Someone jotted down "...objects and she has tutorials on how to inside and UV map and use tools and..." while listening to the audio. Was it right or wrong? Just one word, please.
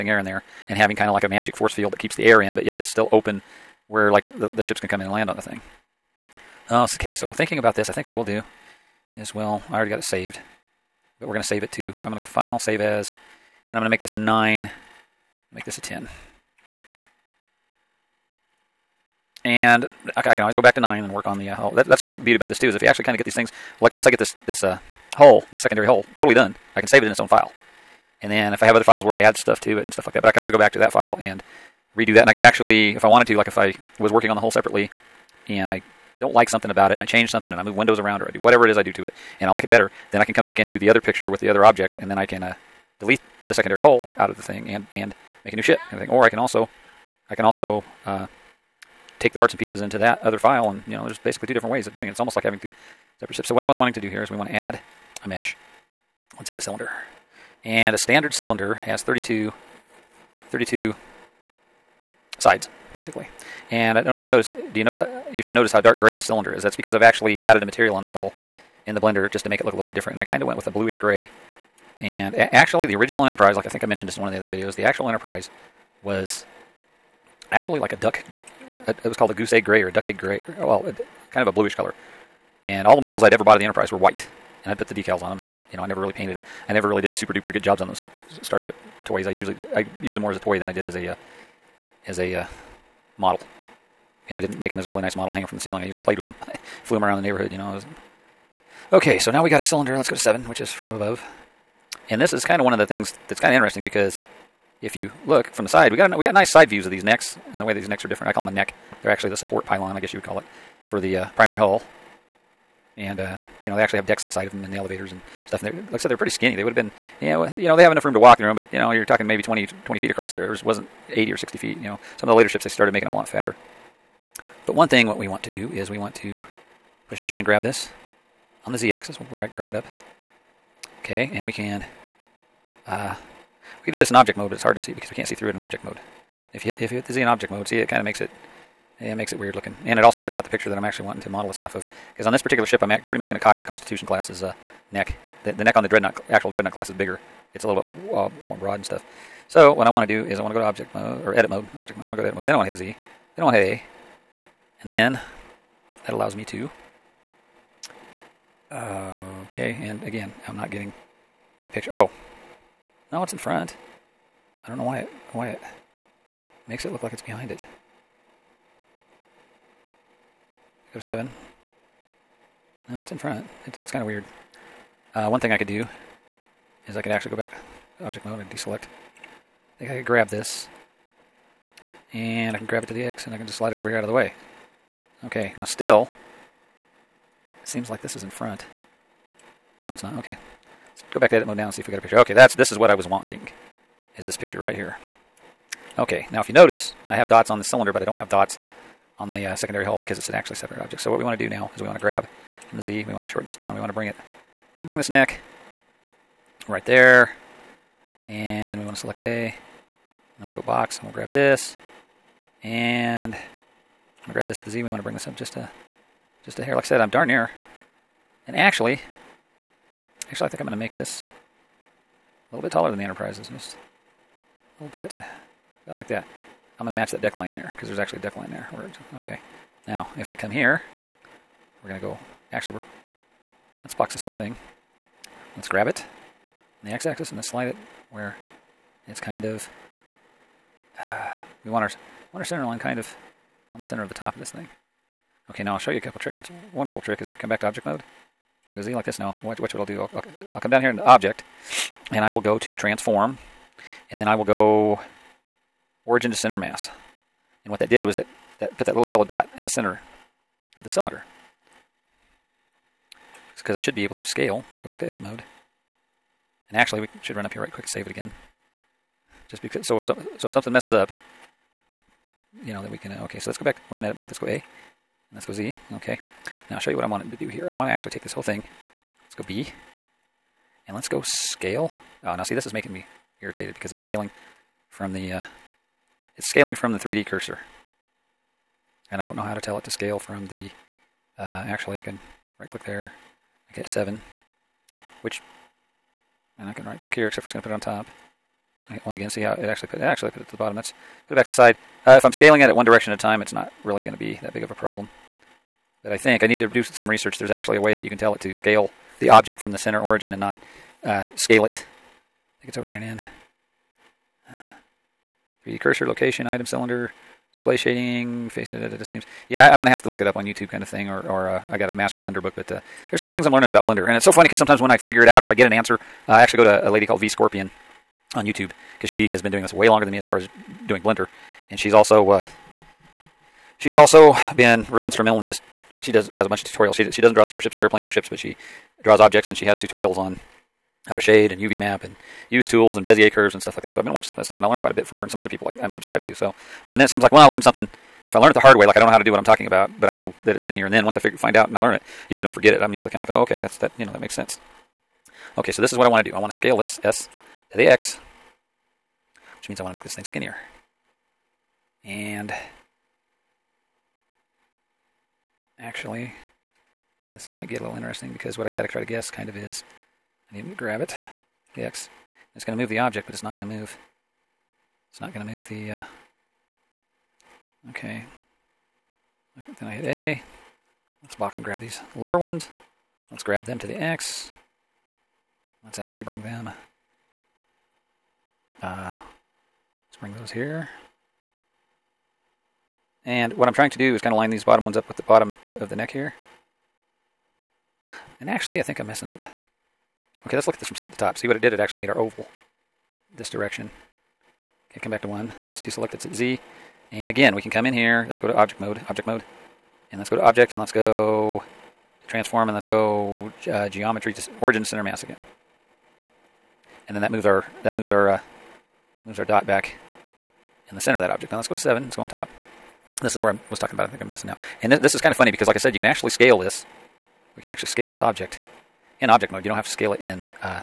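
wrong.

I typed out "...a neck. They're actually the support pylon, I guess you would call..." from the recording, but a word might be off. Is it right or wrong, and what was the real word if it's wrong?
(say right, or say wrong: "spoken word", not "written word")
right.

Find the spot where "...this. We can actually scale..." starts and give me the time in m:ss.
7:06.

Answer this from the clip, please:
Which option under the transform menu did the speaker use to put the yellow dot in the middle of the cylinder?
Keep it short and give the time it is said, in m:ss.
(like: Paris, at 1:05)
Origin to center mass, at 4:16.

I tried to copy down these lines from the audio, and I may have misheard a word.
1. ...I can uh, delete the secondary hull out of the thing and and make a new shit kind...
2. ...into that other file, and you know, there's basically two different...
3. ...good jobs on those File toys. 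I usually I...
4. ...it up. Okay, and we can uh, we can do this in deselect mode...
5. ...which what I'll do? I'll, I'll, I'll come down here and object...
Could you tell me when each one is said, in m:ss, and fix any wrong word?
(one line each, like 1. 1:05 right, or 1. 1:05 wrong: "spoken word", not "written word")
1. 0:42 right
2. 0:49 right
3. 1:27 wrong: "Starship", not "File"
4. 2:09 wrong: "object", not "deselect"
5. 4:09 right.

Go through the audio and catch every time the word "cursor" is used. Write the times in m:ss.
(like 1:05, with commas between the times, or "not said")
4:47, 5:15.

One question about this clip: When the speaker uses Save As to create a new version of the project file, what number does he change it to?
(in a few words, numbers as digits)
10.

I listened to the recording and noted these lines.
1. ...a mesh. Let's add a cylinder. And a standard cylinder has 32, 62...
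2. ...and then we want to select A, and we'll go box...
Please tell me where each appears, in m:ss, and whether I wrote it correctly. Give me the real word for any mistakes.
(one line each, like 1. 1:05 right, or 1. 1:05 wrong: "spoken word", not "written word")
1. 0:55 wrong: "32", not "62"
2. 3:28 right.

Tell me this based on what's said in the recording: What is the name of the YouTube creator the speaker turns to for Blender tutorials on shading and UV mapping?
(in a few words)
V Scorpion.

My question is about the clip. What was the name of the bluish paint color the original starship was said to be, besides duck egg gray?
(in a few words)
Goose egg gray.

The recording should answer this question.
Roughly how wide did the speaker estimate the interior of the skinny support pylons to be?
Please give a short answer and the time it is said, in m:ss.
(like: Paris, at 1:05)
20 feet, at 1:59.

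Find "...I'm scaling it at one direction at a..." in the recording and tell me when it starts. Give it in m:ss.
5:02.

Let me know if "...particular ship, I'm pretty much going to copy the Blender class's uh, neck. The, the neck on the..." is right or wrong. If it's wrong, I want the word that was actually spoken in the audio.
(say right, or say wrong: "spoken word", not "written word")
wrong: "Constitution", not "Blender".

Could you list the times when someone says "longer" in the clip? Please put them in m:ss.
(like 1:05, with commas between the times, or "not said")
5:29.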